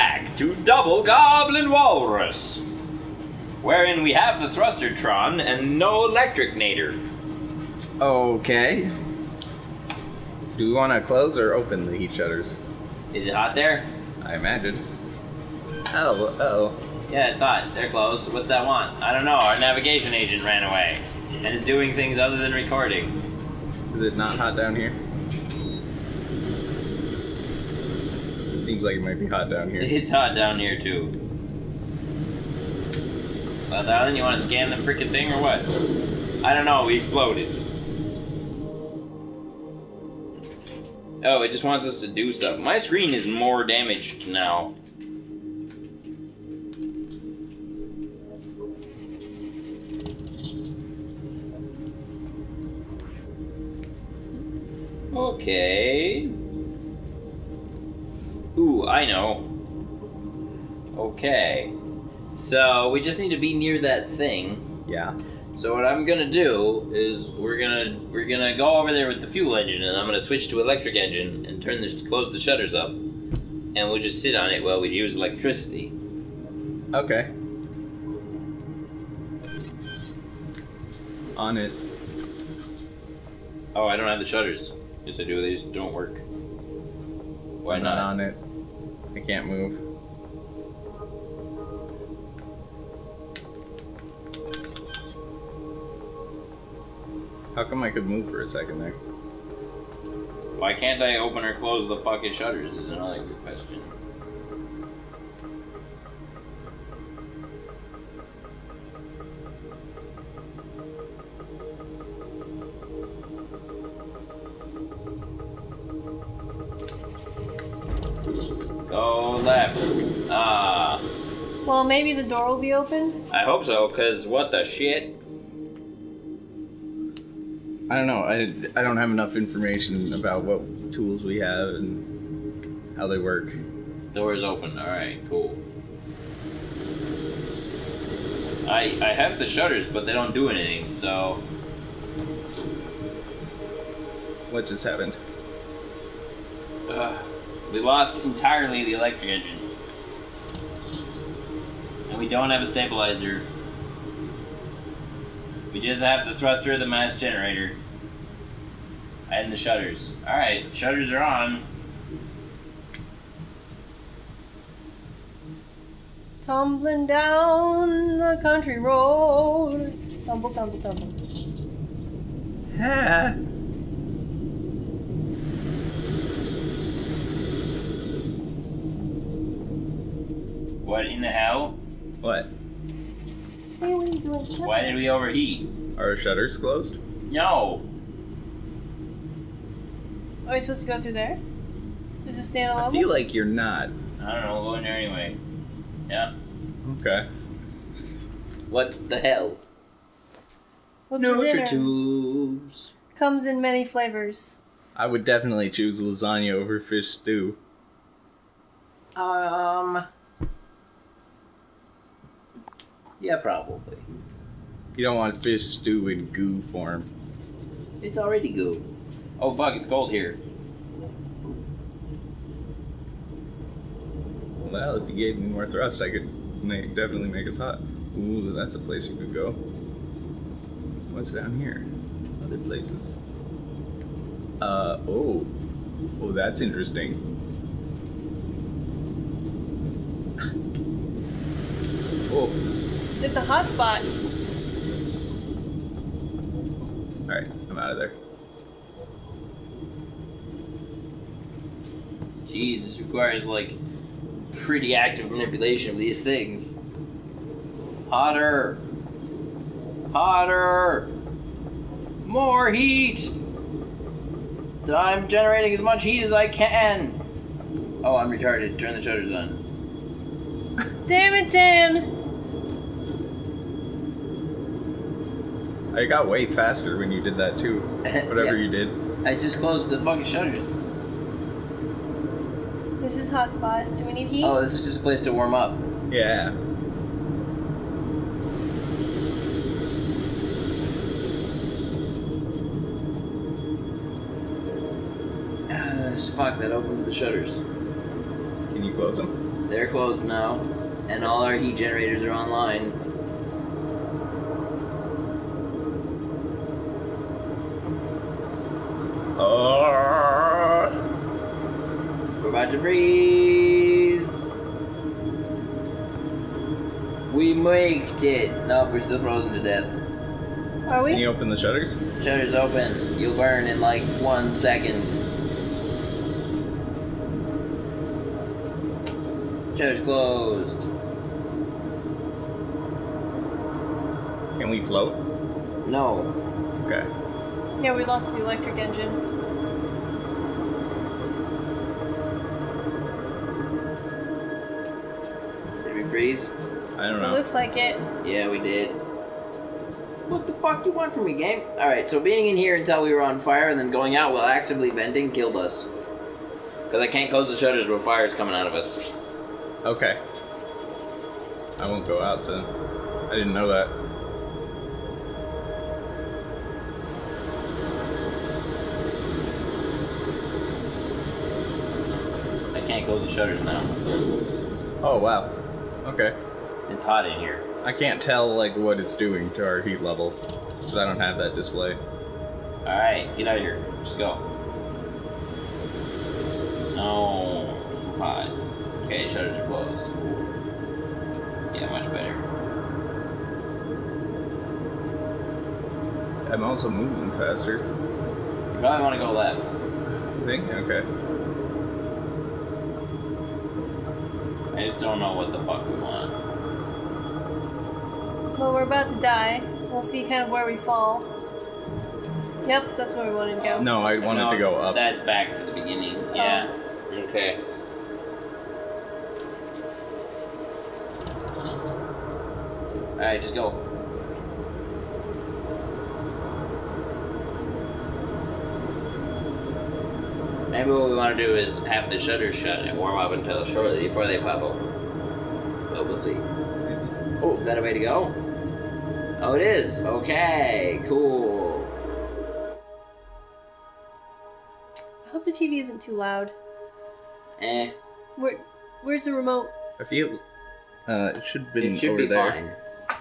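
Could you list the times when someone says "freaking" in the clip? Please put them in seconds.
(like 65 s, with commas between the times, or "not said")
34 s.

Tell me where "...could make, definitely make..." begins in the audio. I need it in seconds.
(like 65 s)
226 s.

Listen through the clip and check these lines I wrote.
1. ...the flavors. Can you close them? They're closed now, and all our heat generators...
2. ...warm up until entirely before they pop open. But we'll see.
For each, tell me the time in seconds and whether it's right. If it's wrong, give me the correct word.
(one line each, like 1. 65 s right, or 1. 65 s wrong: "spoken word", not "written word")
1. 297 s wrong: "shutters", not "flavors"
2. 432 s wrong: "shortly", not "entirely".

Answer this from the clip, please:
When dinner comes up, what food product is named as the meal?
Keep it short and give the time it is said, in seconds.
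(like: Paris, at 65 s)
Nutri-tubes, at 201 s.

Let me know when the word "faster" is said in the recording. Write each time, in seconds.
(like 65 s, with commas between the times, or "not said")
276 s, 397 s.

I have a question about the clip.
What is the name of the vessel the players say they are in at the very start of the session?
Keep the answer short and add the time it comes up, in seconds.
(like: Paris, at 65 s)
Double Goblin Walrus, at 0 s.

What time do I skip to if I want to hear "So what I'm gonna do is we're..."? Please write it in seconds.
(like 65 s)
65 s.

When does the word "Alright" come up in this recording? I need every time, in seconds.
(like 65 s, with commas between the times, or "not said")
160 s, 247 s, 351 s, 423 s.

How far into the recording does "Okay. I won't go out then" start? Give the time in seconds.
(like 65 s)
359 s.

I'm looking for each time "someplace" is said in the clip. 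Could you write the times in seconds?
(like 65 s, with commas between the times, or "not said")
not said.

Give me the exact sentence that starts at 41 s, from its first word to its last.
Oh, it just wants us to do stuff.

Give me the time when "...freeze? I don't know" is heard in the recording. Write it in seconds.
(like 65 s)
346 s.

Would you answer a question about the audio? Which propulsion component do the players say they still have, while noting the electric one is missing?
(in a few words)
Thrustertron.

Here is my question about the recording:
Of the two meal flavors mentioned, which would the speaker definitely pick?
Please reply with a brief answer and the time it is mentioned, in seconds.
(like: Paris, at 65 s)
lasagna, at 206 s.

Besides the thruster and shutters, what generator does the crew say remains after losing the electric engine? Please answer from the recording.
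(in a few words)
mass generator.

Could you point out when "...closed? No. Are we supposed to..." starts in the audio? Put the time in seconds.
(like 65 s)
186 s.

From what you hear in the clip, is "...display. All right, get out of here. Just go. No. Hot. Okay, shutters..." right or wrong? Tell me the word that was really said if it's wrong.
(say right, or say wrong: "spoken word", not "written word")
right.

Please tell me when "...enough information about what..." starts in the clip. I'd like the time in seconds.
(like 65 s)
129 s.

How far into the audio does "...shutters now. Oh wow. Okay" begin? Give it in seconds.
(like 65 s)
373 s.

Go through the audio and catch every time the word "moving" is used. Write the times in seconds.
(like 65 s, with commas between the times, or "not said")
396 s.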